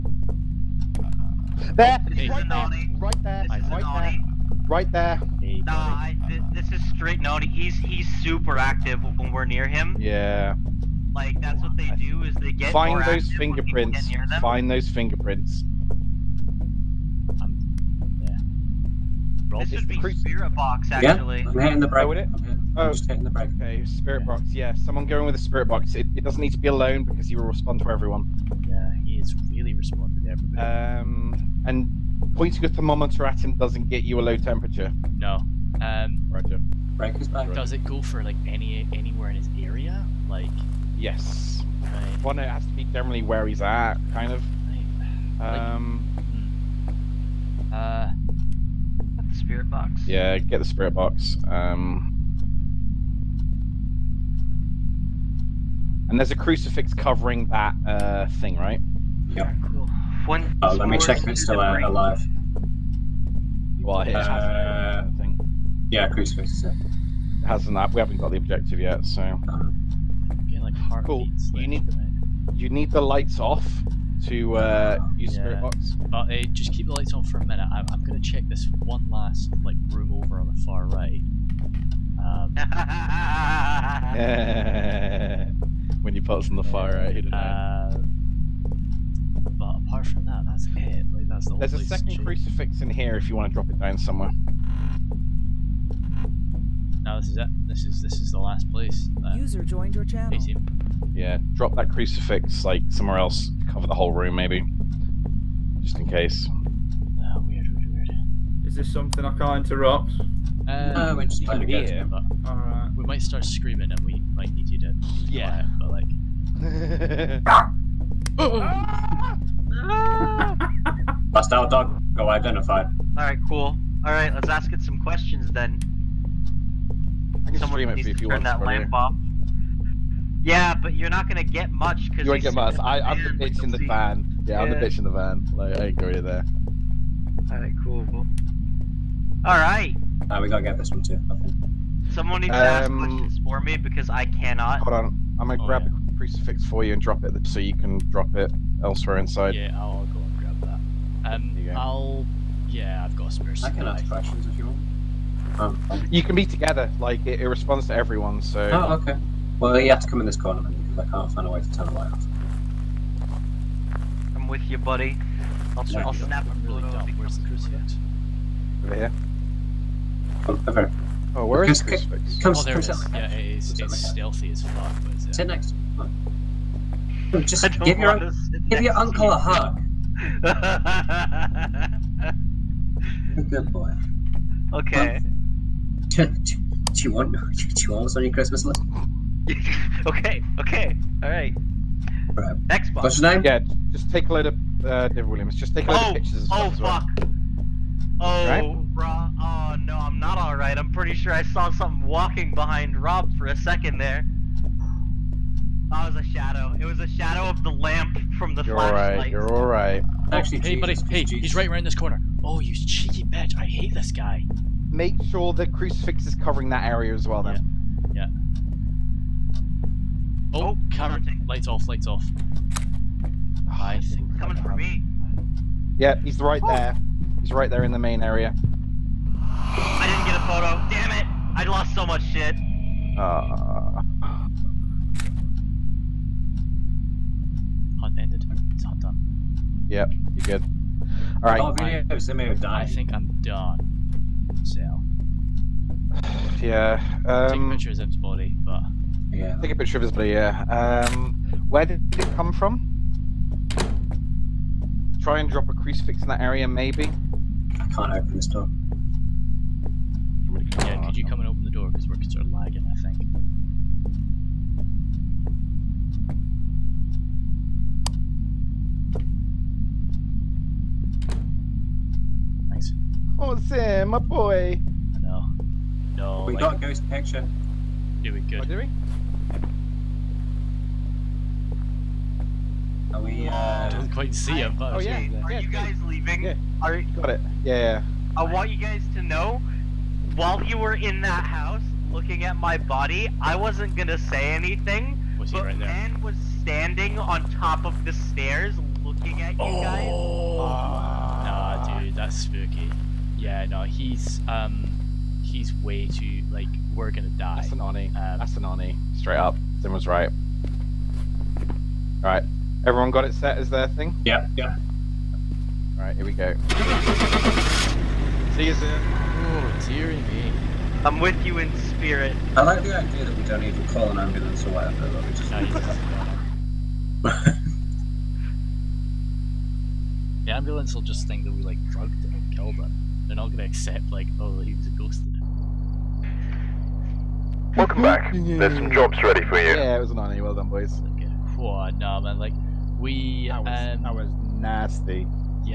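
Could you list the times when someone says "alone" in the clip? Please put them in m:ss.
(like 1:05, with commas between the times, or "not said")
0:26.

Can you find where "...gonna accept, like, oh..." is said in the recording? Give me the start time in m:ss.
5:33.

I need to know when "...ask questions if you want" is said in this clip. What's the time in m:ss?
2:33.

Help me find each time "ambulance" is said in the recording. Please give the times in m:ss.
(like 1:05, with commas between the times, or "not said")
5:24, 5:30.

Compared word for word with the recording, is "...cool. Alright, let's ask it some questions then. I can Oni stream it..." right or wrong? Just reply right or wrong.
wrong.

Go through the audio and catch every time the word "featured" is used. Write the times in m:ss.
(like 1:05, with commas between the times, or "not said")
not said.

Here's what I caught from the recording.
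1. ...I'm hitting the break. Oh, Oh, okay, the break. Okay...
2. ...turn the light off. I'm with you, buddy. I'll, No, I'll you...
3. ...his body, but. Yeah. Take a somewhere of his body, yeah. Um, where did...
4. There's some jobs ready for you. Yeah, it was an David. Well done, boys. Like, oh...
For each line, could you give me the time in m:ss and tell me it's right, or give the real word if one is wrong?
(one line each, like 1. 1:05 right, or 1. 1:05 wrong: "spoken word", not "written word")
1. 0:21 right
2. 2:41 right
3. 4:08 wrong: "picture", not "somewhere"
4. 5:38 wrong: "Oni", not "David".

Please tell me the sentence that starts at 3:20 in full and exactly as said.
I'm pretty sure I saw something walking behind Rob for a second there.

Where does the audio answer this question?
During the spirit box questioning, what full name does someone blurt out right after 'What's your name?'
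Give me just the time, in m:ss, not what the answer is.
3:15.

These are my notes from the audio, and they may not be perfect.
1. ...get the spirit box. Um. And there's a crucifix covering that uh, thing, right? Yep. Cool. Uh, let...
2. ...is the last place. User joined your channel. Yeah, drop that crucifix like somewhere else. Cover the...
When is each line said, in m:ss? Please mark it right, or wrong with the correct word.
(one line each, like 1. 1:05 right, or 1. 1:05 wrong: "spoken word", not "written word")
1. 0:50 right
2. 1:38 right.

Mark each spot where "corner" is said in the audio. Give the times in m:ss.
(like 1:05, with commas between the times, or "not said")
2:40, 3:31.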